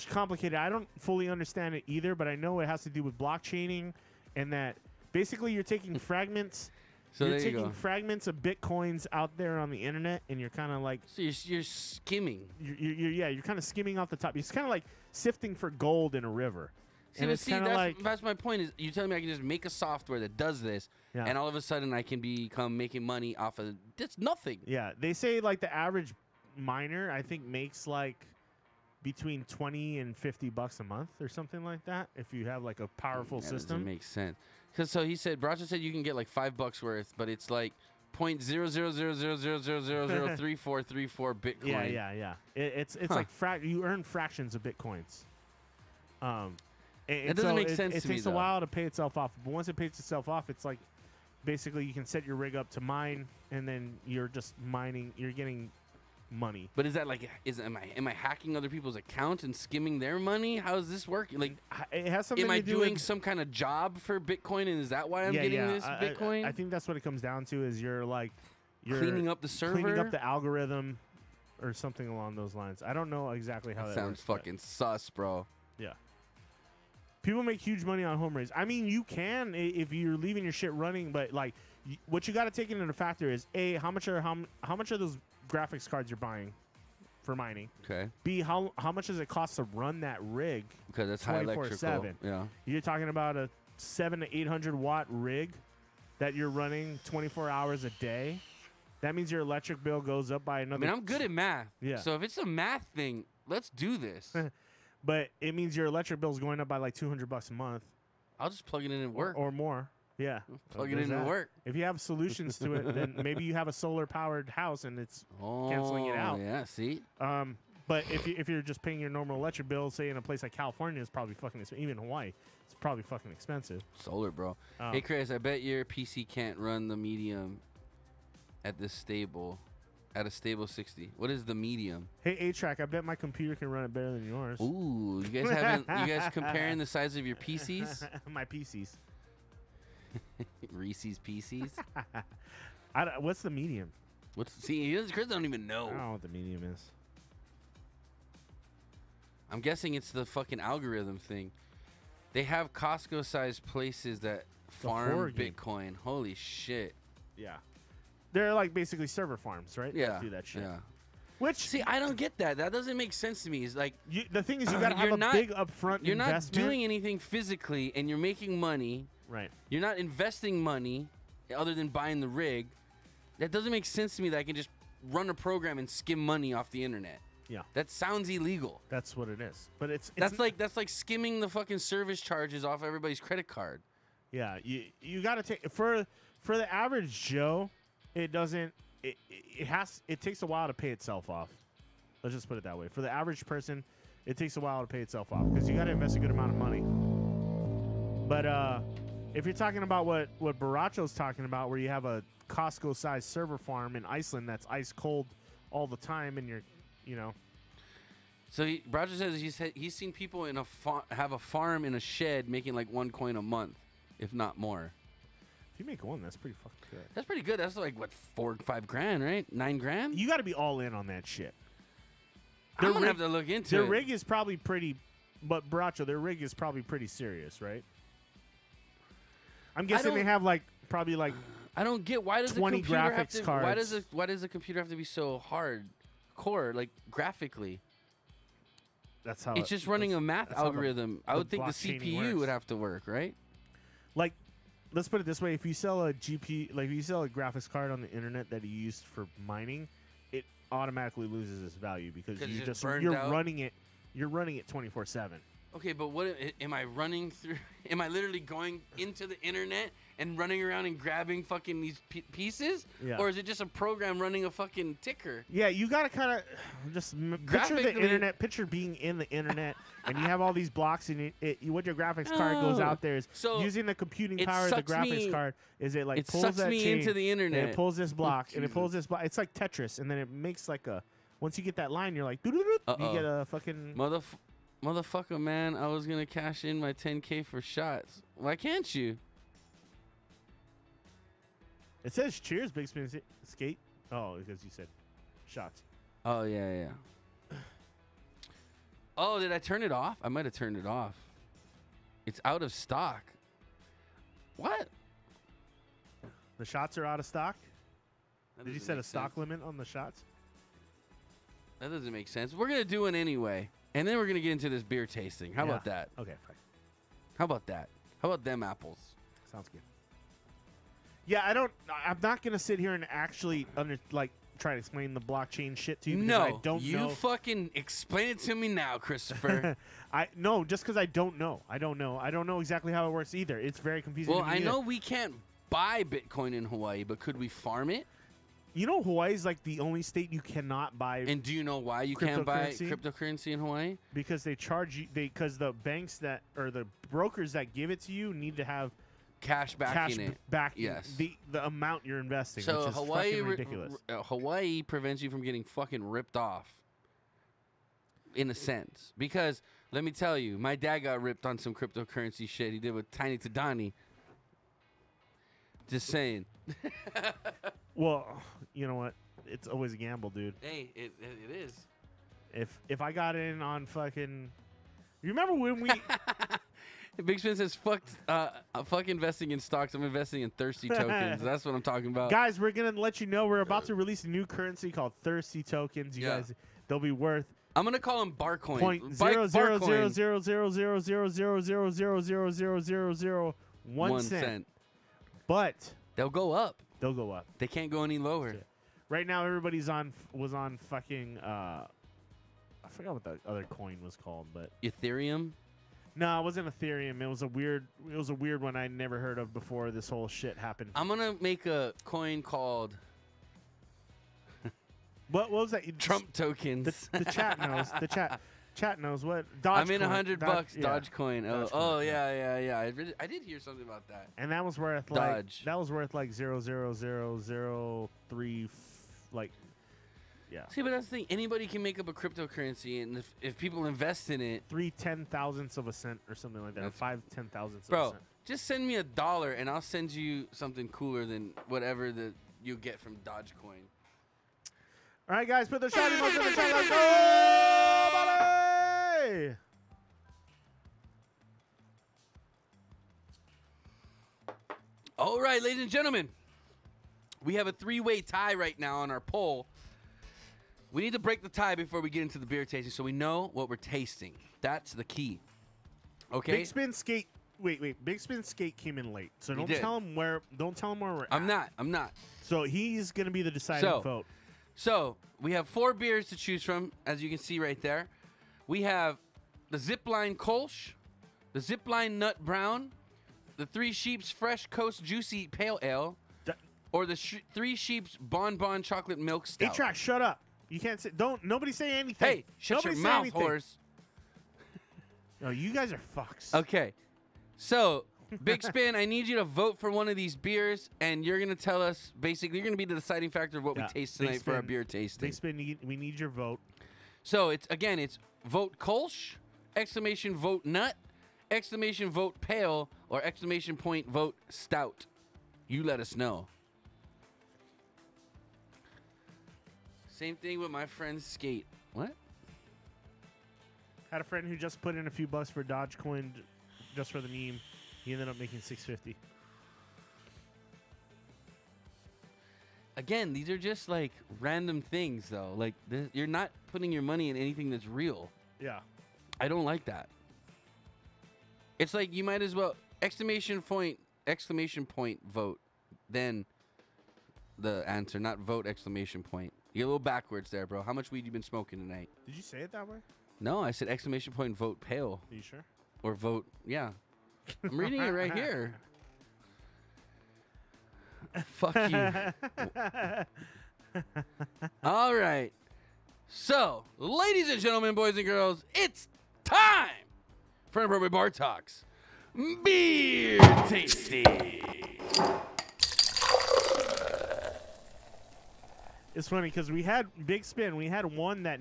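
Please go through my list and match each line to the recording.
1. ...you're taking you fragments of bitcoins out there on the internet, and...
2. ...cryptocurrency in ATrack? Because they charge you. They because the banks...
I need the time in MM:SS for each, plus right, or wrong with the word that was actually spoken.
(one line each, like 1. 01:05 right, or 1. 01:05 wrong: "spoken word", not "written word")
1. 00:07 right
2. 05:42 wrong: "Hawaii", not "ATrack".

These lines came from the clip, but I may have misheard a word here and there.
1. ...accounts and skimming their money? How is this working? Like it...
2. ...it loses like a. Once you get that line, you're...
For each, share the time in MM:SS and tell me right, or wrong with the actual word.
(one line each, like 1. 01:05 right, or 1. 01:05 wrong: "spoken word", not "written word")
1. 00:58 right
2. 04:40 wrong: "makes", not "loses".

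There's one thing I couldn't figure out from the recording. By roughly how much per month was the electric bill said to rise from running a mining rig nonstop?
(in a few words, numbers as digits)
200 dollars.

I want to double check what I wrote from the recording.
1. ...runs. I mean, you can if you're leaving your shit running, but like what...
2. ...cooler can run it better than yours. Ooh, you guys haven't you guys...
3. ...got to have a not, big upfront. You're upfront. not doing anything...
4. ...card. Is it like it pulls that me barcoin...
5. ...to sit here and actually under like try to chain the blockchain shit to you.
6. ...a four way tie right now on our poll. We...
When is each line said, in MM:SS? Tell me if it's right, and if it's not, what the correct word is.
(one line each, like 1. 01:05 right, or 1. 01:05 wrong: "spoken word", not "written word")
1. 01:18 right
2. 02:13 wrong: "computer", not "cooler"
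3. 02:44 wrong: "investment", not "upfront"
4. 04:35 wrong: "chain", not "barcoin"
5. 05:22 wrong: "explain", not "chain"
6. 07:37 wrong: "three", not "four".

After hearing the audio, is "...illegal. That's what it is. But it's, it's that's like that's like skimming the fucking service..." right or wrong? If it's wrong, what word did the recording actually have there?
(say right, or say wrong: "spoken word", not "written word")
right.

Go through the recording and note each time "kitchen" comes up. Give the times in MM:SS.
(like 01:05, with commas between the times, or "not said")
not said.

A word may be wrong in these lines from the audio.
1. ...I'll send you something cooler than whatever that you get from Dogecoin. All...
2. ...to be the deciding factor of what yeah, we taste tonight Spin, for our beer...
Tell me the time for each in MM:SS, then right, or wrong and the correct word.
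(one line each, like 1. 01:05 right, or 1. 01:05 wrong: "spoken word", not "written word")
1. 07:19 right
2. 08:22 right.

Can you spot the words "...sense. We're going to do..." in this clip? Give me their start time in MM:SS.
05:12.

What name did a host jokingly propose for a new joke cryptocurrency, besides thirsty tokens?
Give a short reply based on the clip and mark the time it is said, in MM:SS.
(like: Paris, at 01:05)
barcoin, at 06:28.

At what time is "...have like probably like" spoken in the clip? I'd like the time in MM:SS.
03:50.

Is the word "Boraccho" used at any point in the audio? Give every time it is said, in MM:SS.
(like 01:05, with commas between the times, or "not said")
00:35, 03:20, 03:45.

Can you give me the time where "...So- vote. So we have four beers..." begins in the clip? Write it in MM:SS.
07:53.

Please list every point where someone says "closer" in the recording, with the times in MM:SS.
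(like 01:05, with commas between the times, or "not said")
not said.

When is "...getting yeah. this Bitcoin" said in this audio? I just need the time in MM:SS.
01:05.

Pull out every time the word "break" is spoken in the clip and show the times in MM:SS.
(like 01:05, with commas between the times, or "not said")
07:41.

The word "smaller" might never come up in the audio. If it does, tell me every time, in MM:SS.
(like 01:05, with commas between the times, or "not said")
not said.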